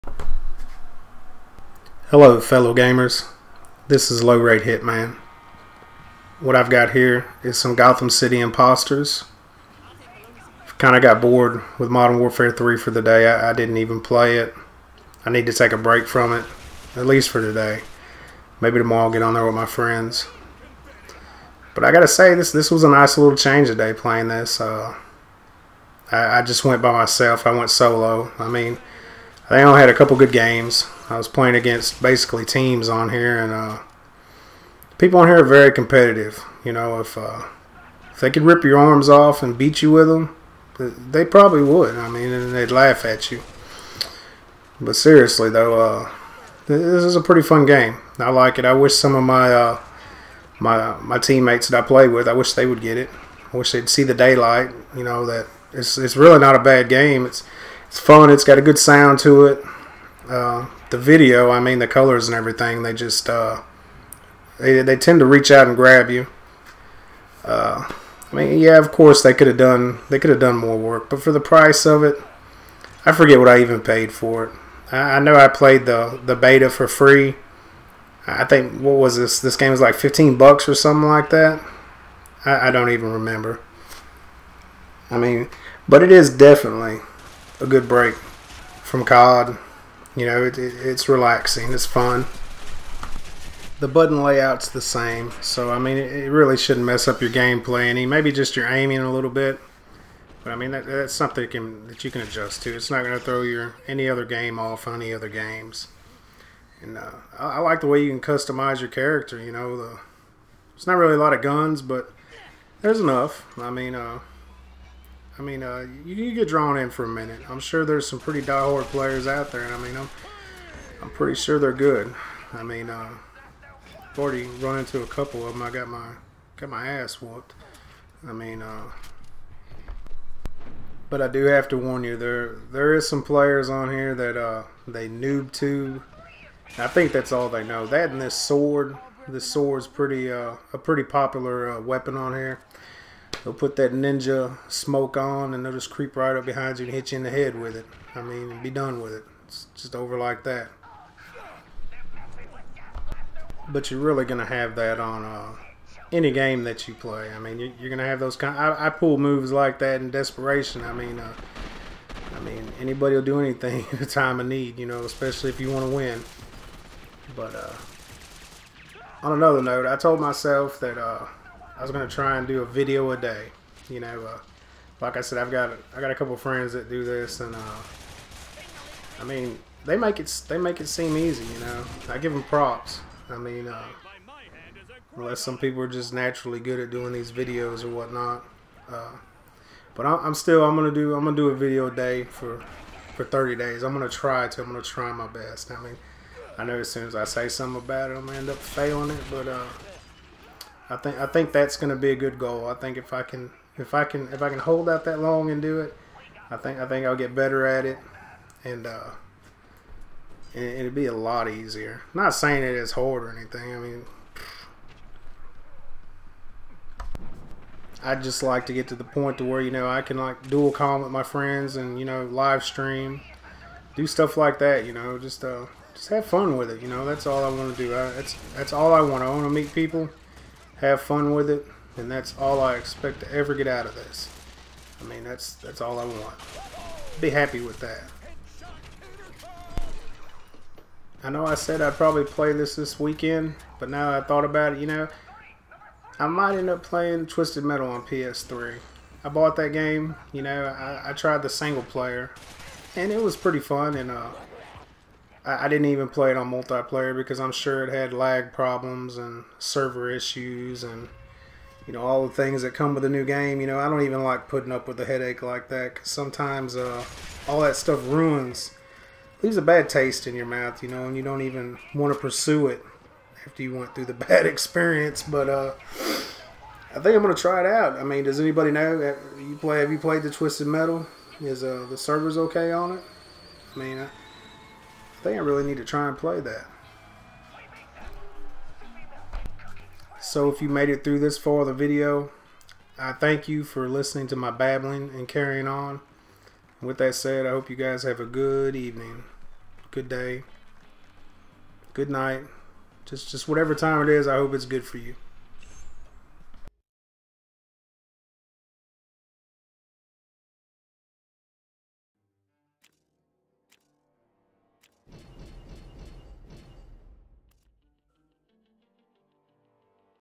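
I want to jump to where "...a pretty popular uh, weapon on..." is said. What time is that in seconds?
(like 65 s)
140 s.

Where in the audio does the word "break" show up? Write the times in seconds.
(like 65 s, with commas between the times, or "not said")
15 s, 87 s.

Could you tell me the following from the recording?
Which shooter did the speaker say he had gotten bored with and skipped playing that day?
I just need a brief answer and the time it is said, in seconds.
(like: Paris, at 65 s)
Modern Warfare 3, at 11 s.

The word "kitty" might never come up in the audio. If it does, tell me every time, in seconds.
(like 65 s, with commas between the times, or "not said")
not said.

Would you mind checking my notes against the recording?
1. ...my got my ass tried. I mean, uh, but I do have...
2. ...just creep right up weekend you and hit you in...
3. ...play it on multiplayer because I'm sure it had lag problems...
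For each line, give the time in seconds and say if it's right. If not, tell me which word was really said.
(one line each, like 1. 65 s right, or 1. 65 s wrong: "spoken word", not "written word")
1. 125 s wrong: "whooped", not "tried"
2. 145 s wrong: "behind", not "weekend"
3. 256 s right.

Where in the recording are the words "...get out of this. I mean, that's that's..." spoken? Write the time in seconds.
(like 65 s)
233 s.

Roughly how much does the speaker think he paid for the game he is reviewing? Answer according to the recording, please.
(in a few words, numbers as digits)
$15.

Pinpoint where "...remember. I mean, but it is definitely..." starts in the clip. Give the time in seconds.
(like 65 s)
83 s.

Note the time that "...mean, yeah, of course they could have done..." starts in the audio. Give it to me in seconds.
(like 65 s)
68 s.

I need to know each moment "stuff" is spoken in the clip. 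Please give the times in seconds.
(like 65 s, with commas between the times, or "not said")
224 s, 267 s.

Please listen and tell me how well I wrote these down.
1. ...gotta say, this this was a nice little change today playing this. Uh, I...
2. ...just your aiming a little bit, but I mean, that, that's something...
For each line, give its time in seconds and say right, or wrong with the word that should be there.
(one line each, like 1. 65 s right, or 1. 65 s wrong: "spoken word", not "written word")
1. 21 s right
2. 98 s right.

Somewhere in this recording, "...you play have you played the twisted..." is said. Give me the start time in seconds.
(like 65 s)
279 s.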